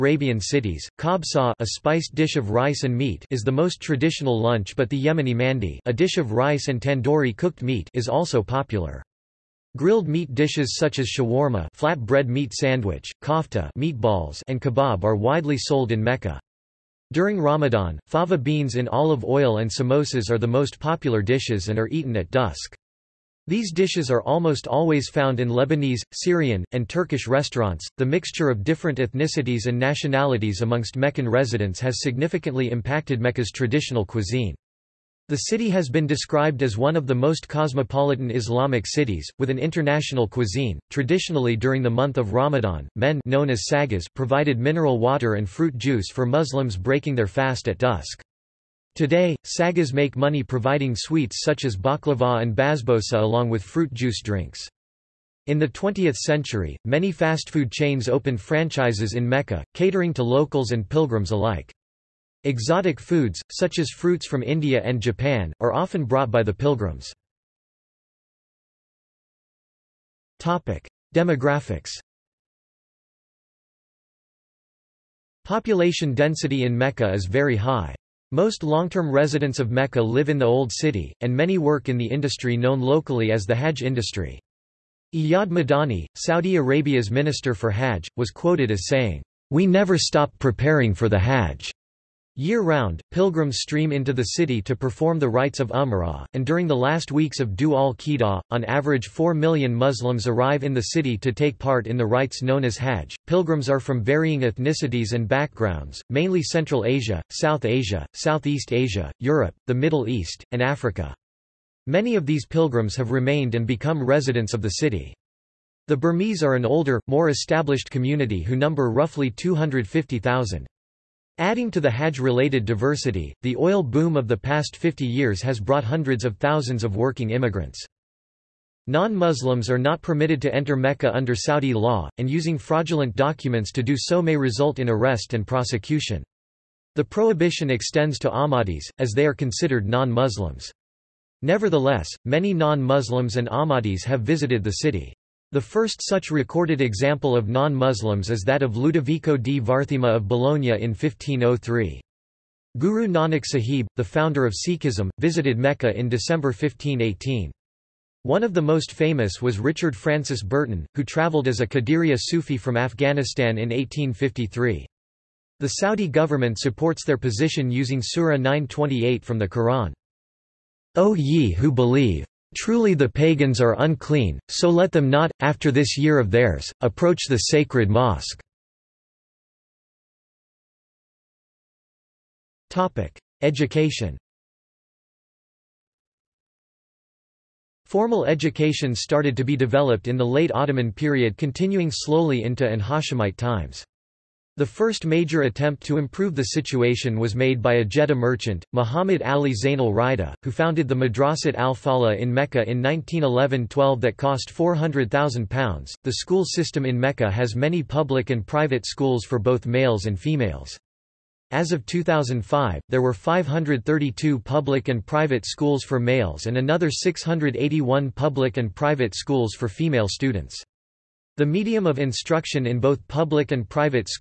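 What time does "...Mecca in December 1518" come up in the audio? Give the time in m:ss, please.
2:35.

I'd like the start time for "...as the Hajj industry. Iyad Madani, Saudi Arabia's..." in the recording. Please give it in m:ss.
1:23.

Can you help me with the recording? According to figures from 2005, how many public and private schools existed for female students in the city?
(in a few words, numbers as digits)
681.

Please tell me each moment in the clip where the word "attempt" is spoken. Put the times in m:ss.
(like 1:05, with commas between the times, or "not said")
3:15.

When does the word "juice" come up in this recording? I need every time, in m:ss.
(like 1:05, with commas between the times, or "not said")
0:45, 0:53.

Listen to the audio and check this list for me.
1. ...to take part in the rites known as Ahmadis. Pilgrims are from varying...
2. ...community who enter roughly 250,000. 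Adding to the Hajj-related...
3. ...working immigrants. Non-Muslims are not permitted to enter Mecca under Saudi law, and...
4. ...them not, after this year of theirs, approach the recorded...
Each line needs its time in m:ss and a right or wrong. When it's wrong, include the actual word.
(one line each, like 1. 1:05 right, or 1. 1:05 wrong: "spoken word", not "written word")
1. 1:41 wrong: "Hajj", not "Ahmadis"
2. 1:57 wrong: "number", not "enter"
3. 2:06 right
4. 2:54 wrong: "sacred", not "recorded".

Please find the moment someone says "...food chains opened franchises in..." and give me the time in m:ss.
0:57.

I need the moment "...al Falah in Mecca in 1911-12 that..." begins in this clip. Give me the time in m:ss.
3:21.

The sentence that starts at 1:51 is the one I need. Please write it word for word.
Many of these pilgrims have remained and become residents of the city.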